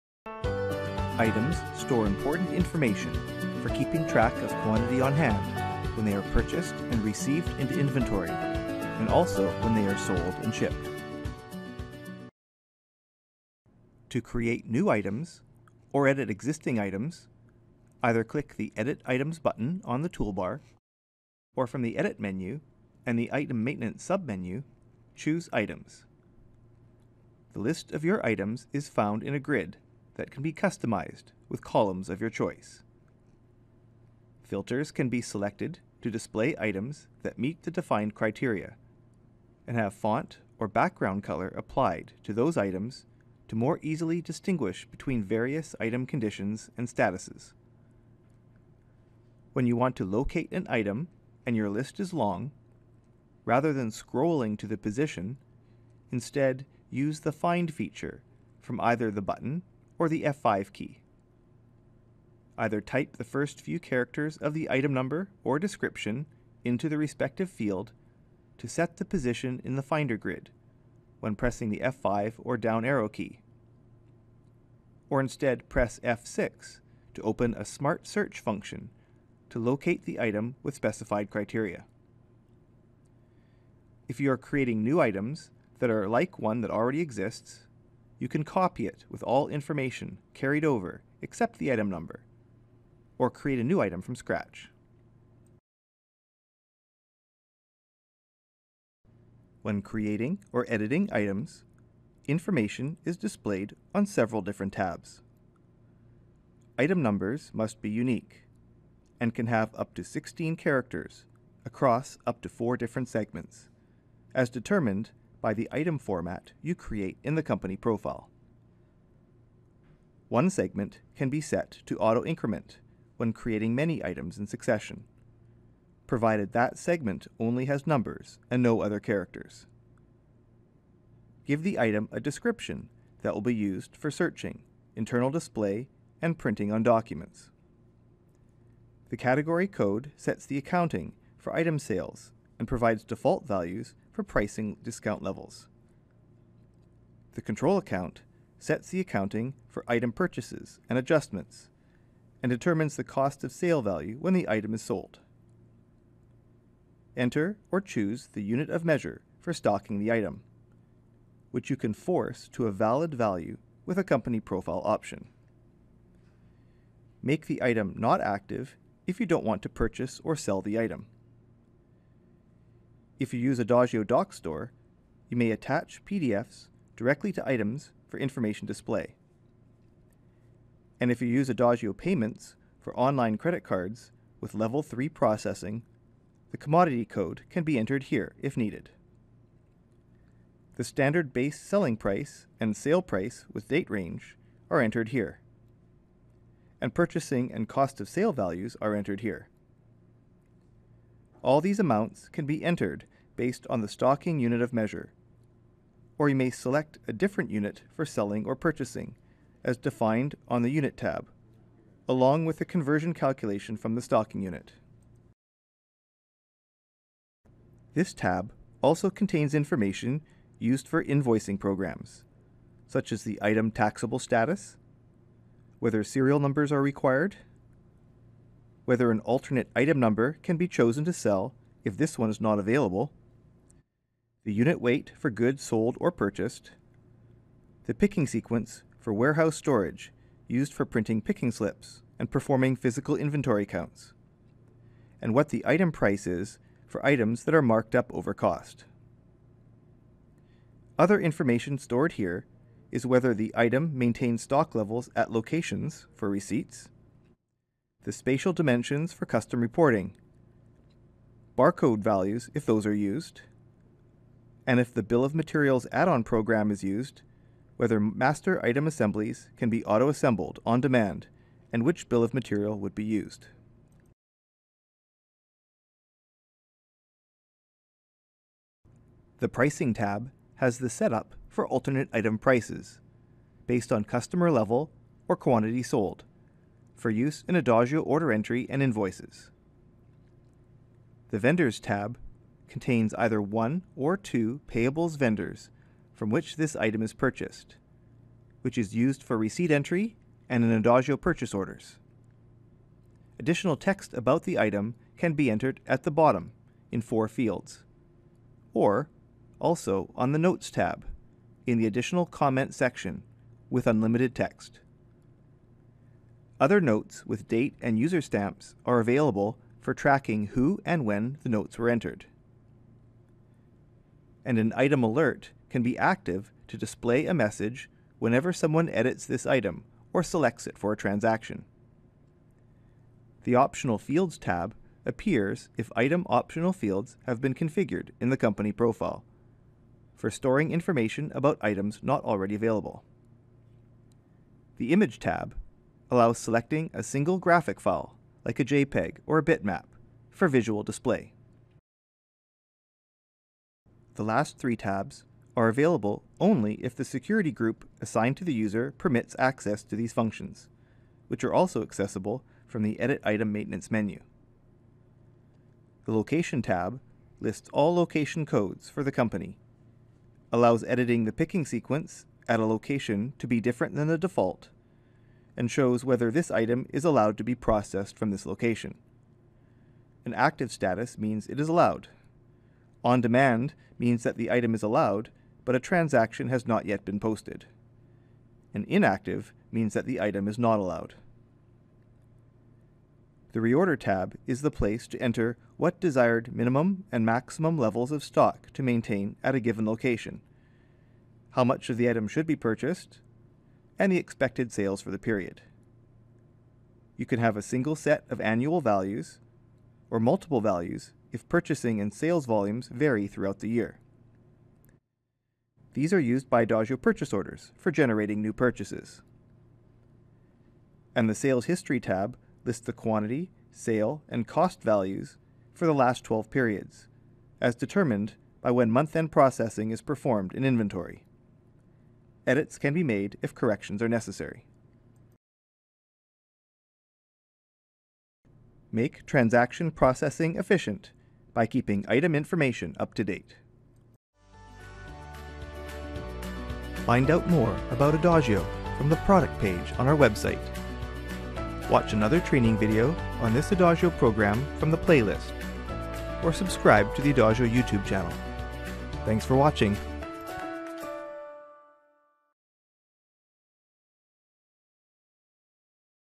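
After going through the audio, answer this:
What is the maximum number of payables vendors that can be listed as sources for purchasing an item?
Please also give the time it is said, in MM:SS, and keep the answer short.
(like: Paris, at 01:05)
2, at 04:54.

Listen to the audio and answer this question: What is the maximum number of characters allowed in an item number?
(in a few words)
16.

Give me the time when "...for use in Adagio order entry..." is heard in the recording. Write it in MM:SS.
04:46.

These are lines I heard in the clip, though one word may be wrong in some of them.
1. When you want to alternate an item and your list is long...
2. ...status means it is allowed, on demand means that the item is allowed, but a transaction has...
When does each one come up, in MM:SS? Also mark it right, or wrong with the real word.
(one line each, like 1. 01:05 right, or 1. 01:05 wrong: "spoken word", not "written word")
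1. 00:49 wrong: "locate", not "alternate"
2. 06:20 right.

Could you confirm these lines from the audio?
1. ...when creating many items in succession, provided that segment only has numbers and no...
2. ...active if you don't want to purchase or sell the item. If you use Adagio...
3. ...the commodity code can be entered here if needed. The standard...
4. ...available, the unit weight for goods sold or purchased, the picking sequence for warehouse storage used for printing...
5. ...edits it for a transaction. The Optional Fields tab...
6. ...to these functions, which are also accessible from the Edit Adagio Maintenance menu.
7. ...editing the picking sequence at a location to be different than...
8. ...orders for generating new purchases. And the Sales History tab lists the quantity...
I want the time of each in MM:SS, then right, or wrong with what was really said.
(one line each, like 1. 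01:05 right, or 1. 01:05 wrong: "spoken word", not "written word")
1. 02:03 right
2. 02:48 right
3. 03:06 right
4. 03:52 right
5. 05:30 wrong: "selects", not "edits"
6. 05:59 wrong: "Item", not "Adagio"
7. 06:10 right
8. 06:57 right.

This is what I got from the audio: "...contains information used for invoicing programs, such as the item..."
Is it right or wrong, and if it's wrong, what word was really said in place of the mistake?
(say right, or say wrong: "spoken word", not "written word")
right.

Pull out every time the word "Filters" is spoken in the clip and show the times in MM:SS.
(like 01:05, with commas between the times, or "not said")
00:34.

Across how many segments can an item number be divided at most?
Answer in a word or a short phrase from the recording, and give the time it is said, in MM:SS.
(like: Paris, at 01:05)
4, at 01:52.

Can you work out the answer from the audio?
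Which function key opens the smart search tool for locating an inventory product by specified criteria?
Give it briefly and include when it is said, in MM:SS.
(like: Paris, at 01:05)
F6, at 01:16.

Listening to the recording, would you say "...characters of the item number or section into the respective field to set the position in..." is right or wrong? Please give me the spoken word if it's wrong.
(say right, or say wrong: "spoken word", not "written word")
wrong: "description", not "section".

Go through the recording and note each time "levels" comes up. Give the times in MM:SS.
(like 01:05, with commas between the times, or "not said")
02:25, 03:04, 04:14, 04:44, 06:37.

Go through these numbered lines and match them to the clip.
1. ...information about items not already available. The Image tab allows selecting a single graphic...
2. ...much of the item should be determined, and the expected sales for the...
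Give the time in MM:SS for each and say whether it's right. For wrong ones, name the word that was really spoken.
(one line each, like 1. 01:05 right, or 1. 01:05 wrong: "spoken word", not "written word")
1. 05:40 right
2. 06:41 wrong: "purchased", not "determined".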